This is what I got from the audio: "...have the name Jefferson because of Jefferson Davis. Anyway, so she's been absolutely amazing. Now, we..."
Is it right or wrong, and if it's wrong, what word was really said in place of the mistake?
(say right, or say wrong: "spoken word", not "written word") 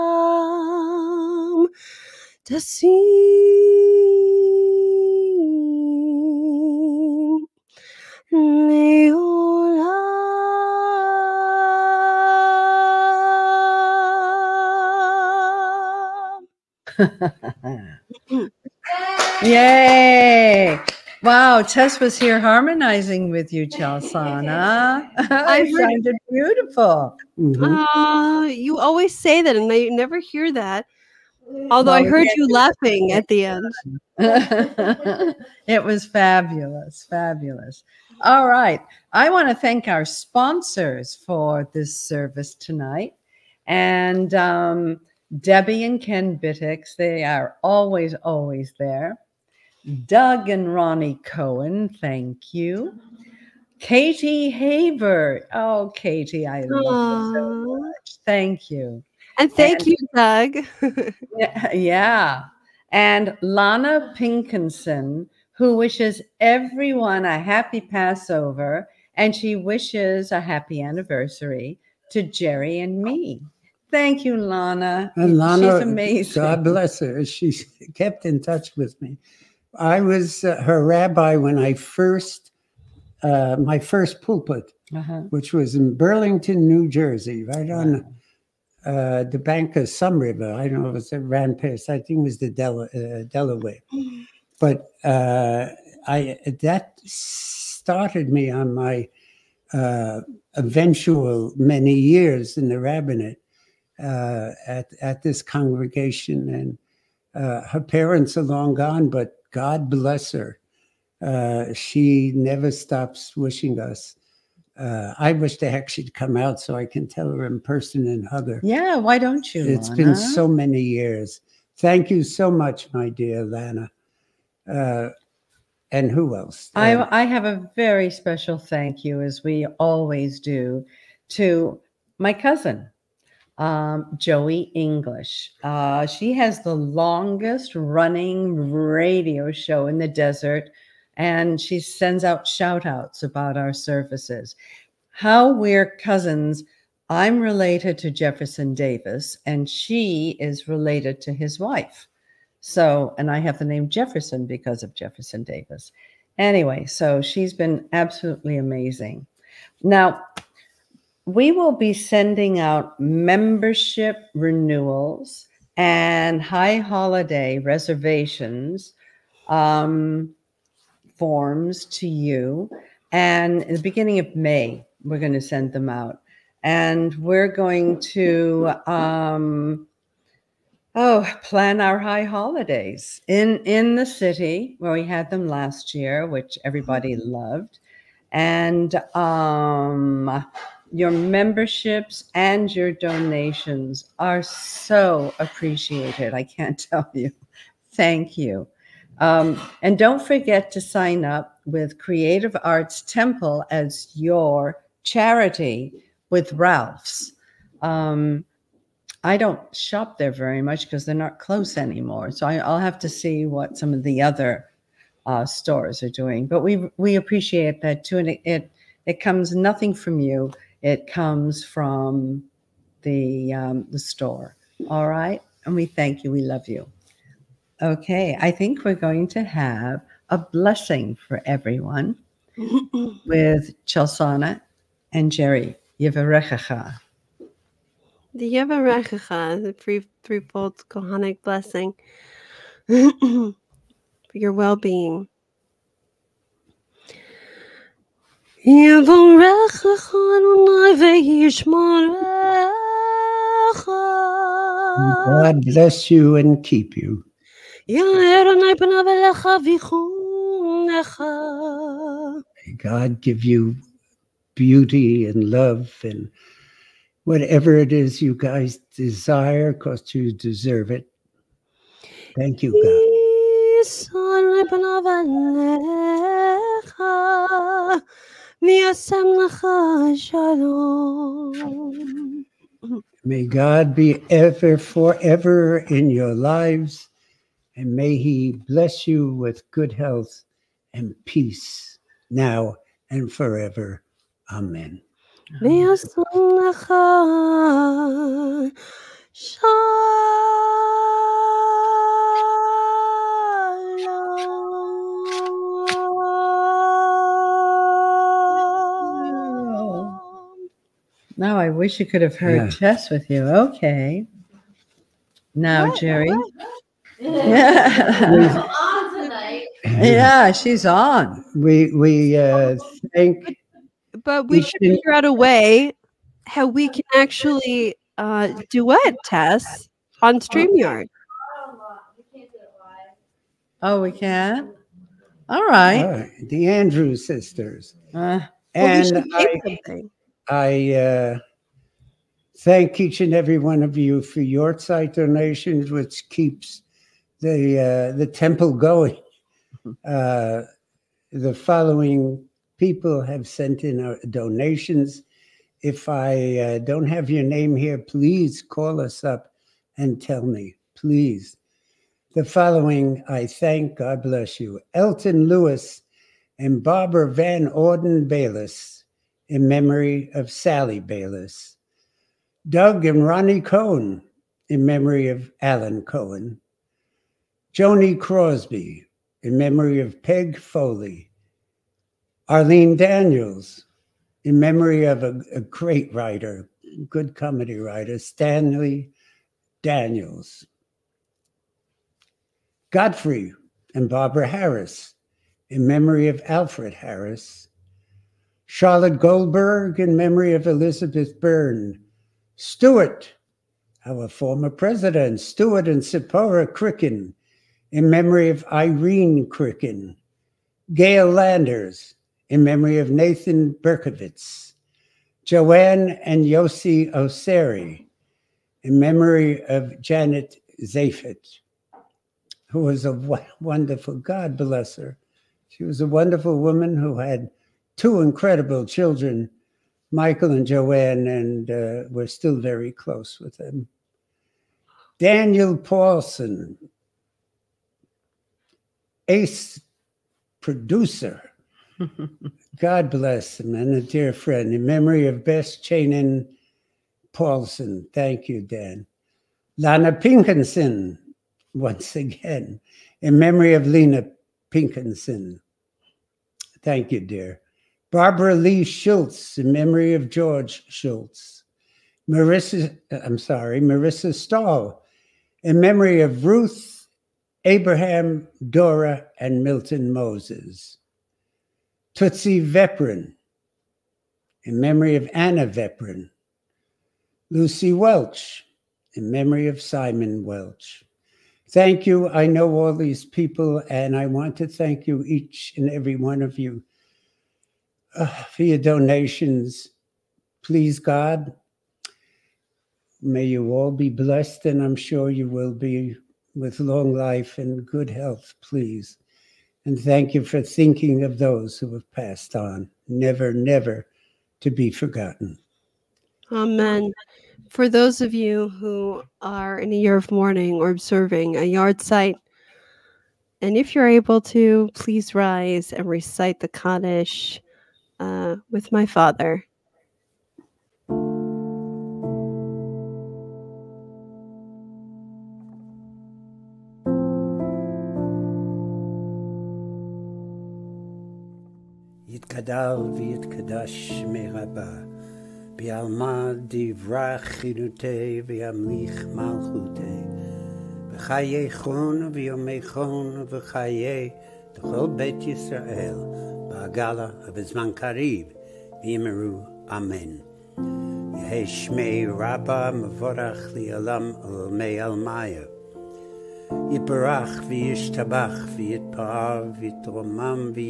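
right.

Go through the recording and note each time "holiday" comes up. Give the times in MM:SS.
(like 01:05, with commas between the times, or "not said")
02:46, 03:02.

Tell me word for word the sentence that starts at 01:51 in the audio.
Uh, she never stops wishing us.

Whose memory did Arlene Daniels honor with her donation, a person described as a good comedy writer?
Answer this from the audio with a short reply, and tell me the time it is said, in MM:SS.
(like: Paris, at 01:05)
Stanley Daniels, at 06:28.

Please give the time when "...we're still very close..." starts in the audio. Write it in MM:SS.
07:12.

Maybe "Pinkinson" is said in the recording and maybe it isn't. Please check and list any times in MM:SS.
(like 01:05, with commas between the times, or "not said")
01:04, 07:30, 07:34.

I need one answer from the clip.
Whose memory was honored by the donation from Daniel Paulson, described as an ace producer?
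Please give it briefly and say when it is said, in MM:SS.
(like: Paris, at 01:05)
Bess Chainin Paulson, at 07:25.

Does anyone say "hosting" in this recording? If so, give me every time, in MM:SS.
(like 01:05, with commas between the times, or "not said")
not said.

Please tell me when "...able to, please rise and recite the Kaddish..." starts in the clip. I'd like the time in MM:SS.
08:34.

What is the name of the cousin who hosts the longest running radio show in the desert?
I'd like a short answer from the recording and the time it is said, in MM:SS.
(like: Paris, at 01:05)
Joey English, at 02:14.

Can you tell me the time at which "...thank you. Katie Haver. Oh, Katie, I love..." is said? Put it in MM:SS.
00:51.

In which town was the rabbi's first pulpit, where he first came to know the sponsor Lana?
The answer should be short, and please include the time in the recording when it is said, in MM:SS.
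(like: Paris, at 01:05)
Burlington, New Jersey, at 01:25.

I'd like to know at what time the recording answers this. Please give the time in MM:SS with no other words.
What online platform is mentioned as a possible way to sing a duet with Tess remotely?
05:30.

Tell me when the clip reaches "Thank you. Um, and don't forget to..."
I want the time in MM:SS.
03:17.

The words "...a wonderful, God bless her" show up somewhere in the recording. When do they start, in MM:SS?
07:03.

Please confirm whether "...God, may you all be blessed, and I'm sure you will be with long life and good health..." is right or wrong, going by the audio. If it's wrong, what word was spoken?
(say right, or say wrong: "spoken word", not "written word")
right.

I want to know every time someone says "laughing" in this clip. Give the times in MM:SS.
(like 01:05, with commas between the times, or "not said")
00:32.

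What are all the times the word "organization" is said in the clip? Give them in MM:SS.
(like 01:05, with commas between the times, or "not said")
not said.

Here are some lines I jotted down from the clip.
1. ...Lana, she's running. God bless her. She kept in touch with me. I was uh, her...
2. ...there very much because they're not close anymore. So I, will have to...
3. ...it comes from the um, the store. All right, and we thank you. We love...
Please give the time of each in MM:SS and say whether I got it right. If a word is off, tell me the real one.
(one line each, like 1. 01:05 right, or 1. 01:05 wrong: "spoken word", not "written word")
1. 01:15 wrong: "amazing", not "running"
2. 03:30 right
3. 03:40 right.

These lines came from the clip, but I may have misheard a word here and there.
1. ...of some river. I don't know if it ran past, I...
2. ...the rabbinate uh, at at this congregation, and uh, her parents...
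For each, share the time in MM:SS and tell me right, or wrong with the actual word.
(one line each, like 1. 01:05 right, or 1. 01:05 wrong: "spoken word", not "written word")
1. 01:29 right
2. 01:42 right.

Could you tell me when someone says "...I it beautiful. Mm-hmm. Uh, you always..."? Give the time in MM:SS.
00:25.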